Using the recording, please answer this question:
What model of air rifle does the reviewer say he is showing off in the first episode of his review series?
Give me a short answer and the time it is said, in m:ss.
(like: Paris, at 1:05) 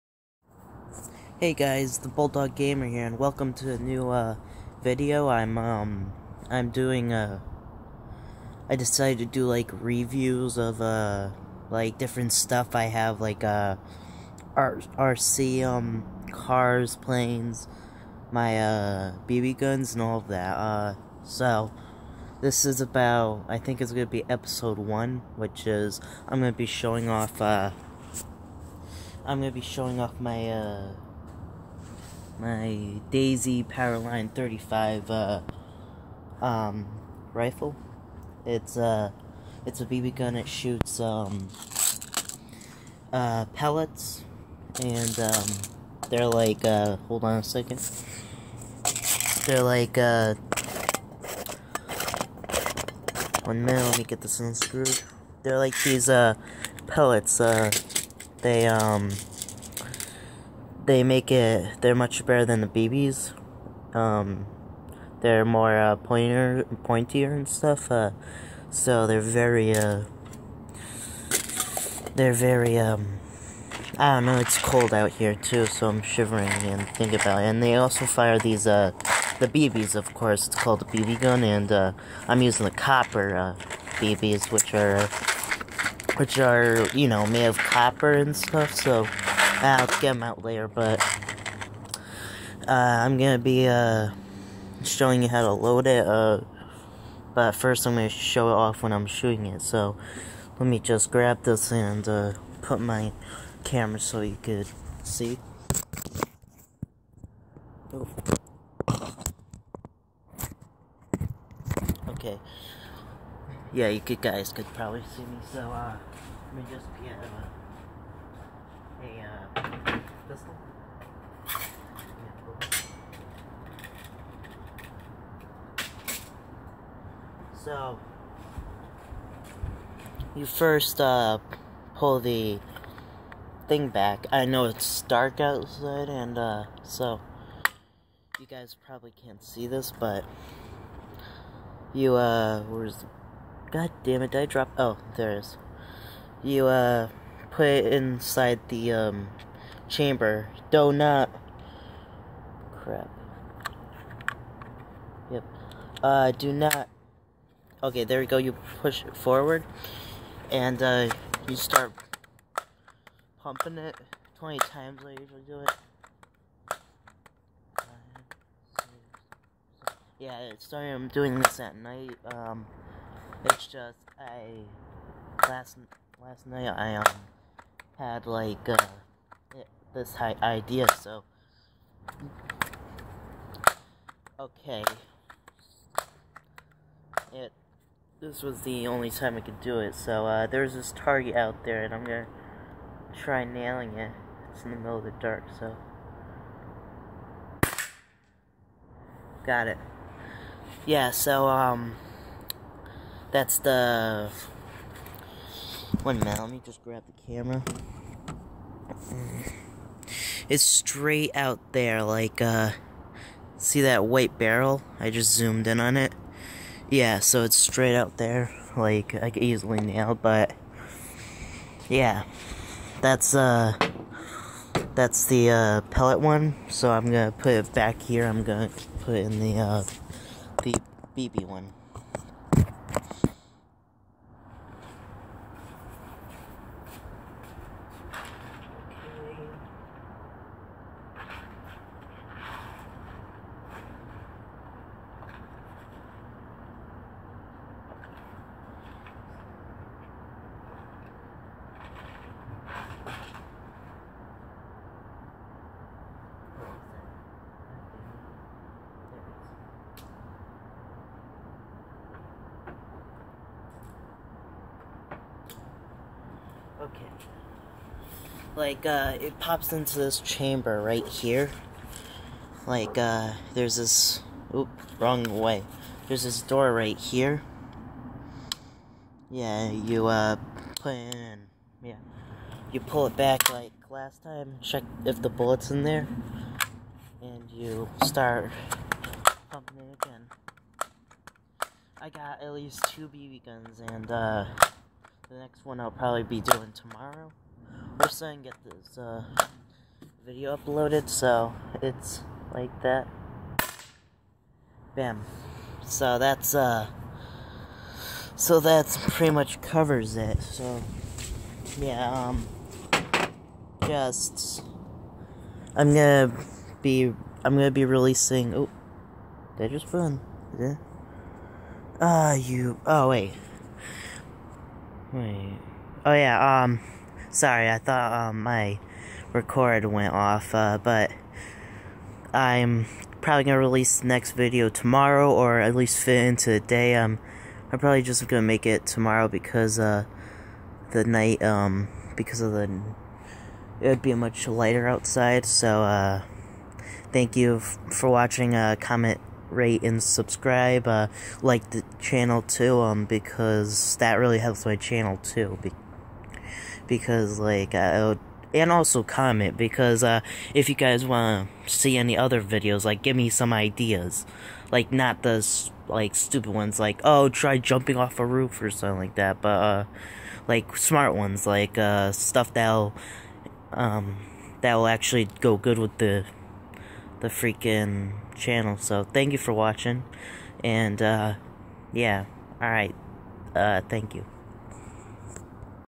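Daisy Powerline 35, at 0:33.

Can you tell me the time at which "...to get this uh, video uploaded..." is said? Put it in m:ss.
4:58.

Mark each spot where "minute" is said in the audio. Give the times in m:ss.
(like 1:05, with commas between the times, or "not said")
0:53, 3:26.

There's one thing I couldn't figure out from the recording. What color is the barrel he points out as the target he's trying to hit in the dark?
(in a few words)
white.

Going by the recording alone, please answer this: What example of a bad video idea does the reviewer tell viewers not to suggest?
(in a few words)
jumping off a roof.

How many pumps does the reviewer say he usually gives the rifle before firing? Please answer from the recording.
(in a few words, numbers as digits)
20.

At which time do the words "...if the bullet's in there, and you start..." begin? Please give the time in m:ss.
4:45.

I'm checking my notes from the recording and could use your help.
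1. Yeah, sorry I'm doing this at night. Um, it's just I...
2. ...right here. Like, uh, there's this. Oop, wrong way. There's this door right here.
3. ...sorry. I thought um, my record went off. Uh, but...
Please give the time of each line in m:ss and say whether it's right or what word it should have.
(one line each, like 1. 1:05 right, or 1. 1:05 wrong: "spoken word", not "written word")
1. 2:50 right
2. 4:30 right
3. 5:27 right.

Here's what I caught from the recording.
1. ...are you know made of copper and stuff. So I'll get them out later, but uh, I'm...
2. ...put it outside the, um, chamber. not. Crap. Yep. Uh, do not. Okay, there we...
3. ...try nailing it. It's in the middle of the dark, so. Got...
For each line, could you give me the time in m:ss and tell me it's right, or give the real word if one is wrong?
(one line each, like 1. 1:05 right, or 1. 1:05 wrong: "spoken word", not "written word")
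1. 1:26 right
2. 2:27 wrong: "inside", not "outside"
3. 3:13 right.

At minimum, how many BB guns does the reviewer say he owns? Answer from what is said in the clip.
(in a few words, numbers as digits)
2.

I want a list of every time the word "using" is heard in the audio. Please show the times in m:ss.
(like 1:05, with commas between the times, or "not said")
1:22.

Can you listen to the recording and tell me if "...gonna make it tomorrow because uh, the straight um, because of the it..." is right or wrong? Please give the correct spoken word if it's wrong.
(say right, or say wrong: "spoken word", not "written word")
wrong: "night", not "straight".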